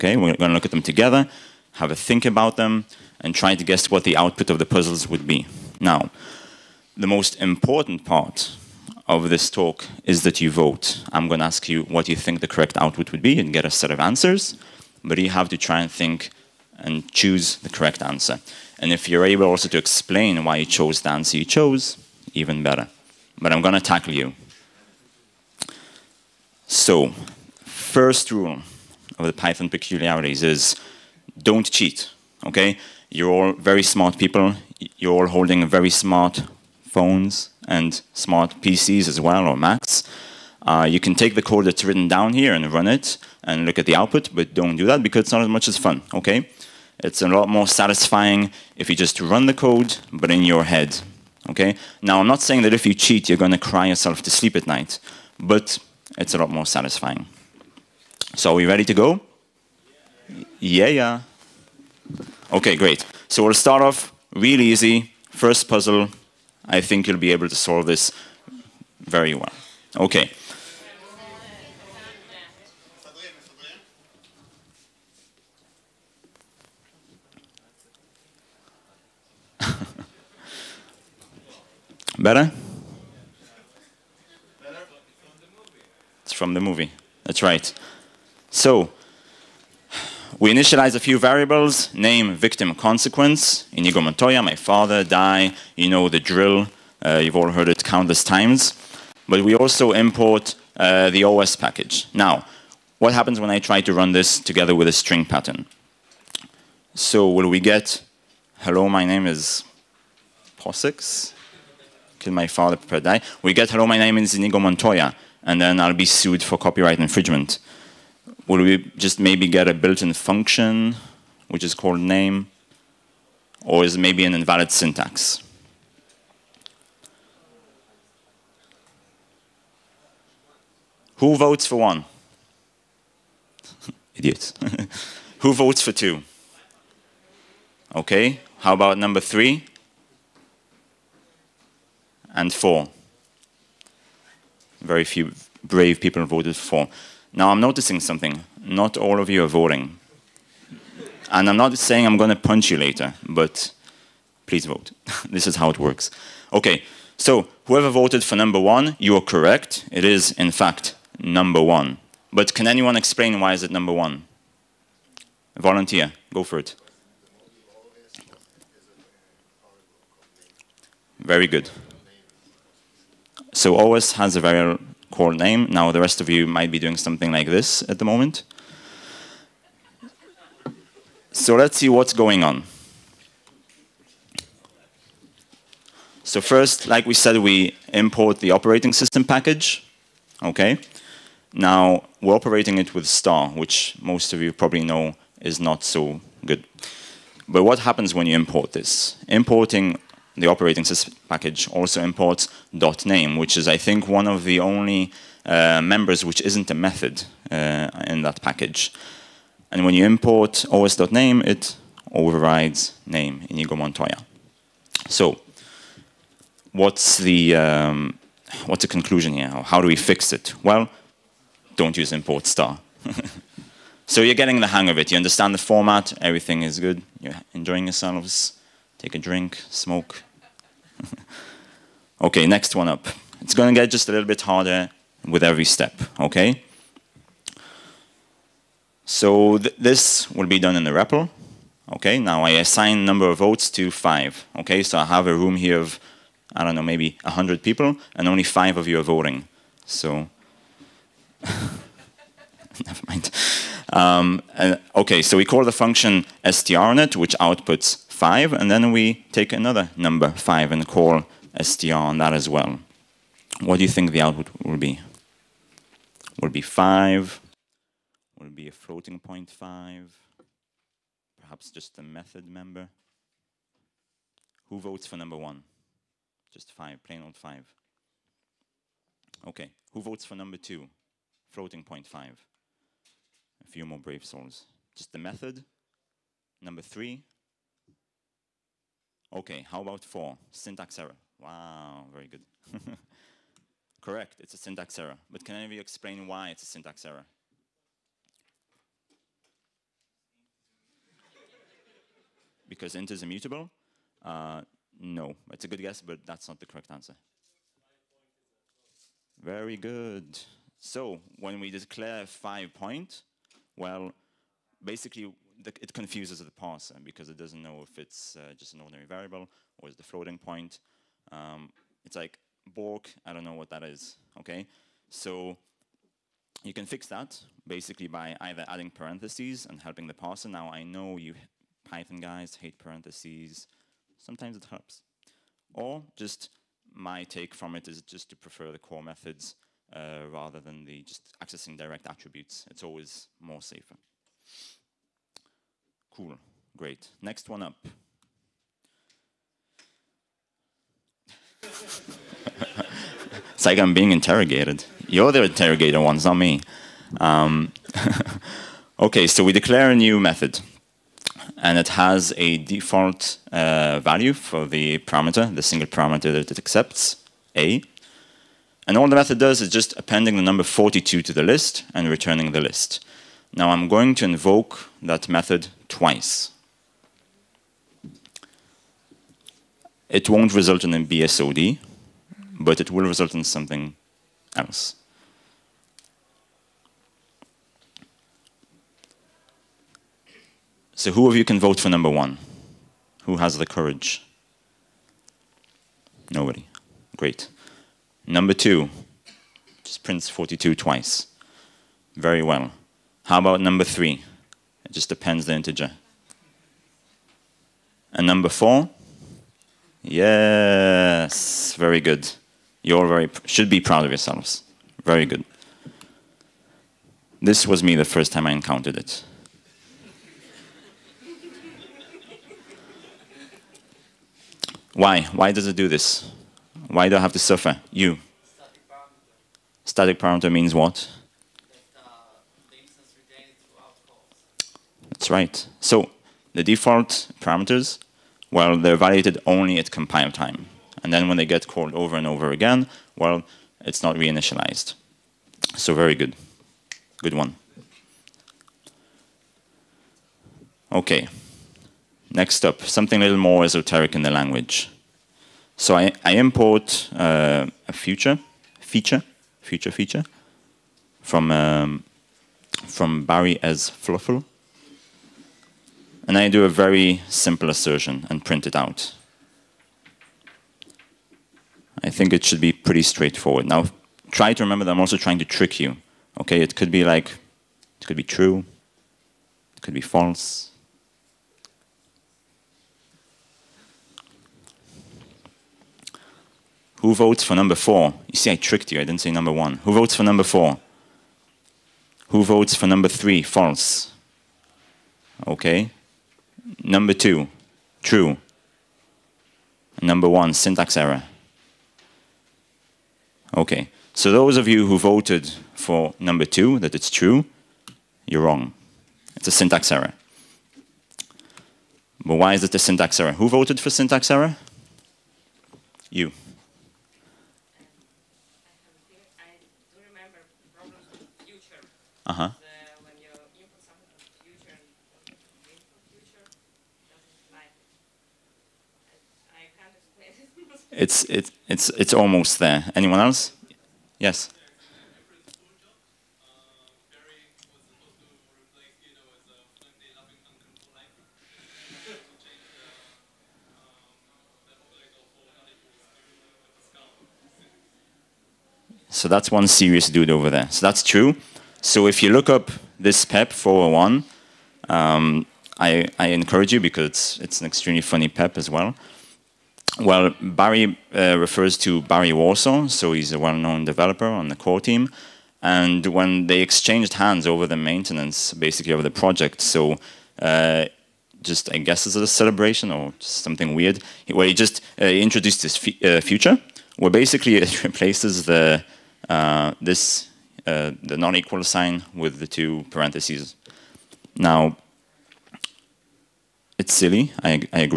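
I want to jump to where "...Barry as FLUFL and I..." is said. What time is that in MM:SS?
07:43.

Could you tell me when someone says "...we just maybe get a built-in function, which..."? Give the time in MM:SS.
01:58.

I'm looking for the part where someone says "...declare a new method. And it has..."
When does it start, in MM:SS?
05:59.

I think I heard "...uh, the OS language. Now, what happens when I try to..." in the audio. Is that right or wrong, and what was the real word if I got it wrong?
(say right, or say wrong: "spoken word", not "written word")
wrong: "package", not "language".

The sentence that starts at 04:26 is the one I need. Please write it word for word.
Will be 5, will be a floating point 5, perhaps just a method member.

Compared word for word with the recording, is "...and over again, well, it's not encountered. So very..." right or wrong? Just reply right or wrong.
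wrong.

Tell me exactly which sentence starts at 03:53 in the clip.
It's going to get just a little bit harder with every step, okay?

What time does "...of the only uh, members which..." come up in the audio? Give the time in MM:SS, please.
03:24.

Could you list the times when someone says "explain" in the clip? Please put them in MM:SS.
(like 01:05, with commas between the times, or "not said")
00:19, 02:42, 04:55.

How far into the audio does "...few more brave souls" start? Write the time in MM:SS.
04:43.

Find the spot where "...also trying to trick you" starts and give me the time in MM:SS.
07:54.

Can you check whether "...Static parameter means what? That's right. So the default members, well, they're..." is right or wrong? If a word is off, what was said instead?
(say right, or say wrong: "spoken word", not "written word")
wrong: "parameters", not "members".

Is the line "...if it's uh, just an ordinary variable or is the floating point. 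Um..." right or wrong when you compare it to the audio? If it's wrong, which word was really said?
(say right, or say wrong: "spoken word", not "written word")
right.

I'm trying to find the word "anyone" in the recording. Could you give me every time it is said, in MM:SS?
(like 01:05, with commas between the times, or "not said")
02:42, 08:52.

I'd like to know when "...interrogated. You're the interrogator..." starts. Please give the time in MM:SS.
05:54.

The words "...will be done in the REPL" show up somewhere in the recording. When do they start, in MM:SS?
04:00.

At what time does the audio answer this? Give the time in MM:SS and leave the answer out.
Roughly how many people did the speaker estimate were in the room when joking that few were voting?
04:07.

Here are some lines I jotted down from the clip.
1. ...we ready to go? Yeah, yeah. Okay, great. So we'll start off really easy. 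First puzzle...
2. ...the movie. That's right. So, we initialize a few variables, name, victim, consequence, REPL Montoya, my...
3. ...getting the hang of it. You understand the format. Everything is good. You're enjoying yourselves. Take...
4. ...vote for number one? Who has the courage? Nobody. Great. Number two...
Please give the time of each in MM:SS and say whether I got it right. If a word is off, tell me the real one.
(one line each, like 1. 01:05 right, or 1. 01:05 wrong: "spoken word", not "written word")
1. 00:58 right
2. 01:26 wrong: "Inigo", not "REPL"
3. 03:44 right
4. 06:31 right.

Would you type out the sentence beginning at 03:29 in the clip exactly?
And when you import os.name, it overrides name, Inigo Montoya.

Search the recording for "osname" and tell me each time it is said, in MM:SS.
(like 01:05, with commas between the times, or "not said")
03:30.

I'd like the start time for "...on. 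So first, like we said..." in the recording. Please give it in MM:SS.
03:02.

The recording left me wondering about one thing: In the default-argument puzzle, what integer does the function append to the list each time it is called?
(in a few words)
42.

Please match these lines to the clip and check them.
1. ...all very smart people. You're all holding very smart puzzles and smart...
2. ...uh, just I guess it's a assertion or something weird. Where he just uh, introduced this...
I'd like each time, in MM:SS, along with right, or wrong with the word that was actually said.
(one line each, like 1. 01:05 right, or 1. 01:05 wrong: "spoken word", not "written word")
1. 00:33 wrong: "phones", not "puzzles"
2. 09:30 wrong: "celebration", not "assertion".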